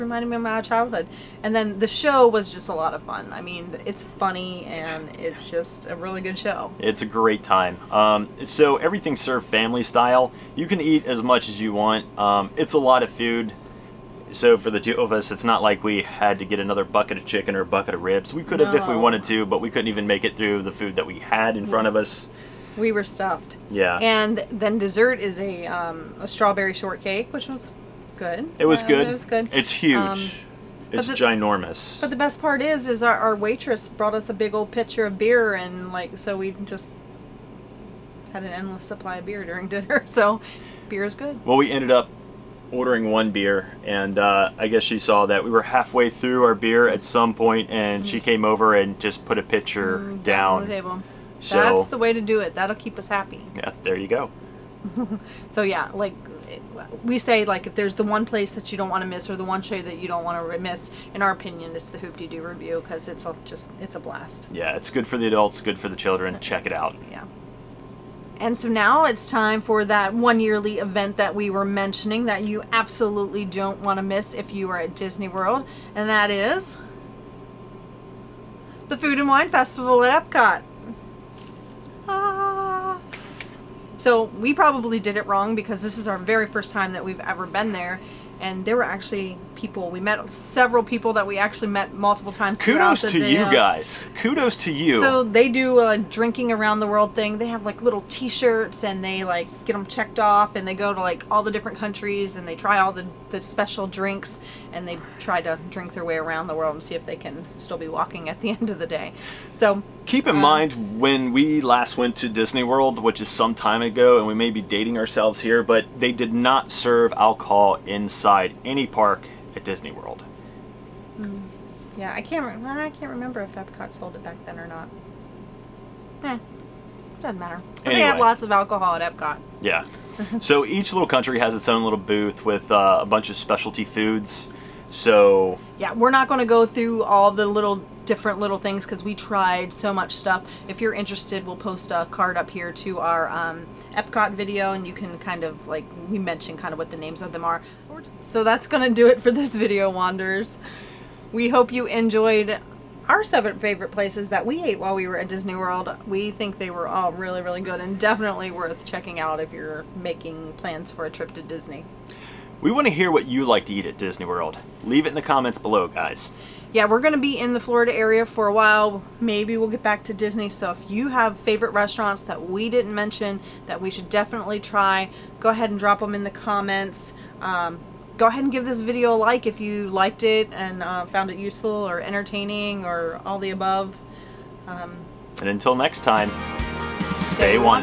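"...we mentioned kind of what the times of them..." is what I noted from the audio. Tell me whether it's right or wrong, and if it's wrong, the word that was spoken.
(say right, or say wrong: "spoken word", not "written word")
wrong: "names", not "times".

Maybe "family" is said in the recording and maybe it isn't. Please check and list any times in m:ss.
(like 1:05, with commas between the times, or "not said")
0:09.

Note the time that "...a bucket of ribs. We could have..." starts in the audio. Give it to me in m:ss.
0:17.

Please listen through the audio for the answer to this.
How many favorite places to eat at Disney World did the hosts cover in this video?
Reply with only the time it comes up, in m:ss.
2:33.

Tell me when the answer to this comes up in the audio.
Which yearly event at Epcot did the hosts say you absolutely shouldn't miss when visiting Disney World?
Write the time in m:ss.
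1:18.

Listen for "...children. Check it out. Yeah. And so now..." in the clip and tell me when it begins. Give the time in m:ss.
1:05.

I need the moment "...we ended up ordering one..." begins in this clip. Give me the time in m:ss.
0:41.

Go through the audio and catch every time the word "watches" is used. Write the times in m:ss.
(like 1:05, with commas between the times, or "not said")
not said.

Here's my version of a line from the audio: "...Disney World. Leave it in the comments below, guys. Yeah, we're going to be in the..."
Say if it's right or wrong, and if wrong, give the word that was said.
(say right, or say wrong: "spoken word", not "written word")
right.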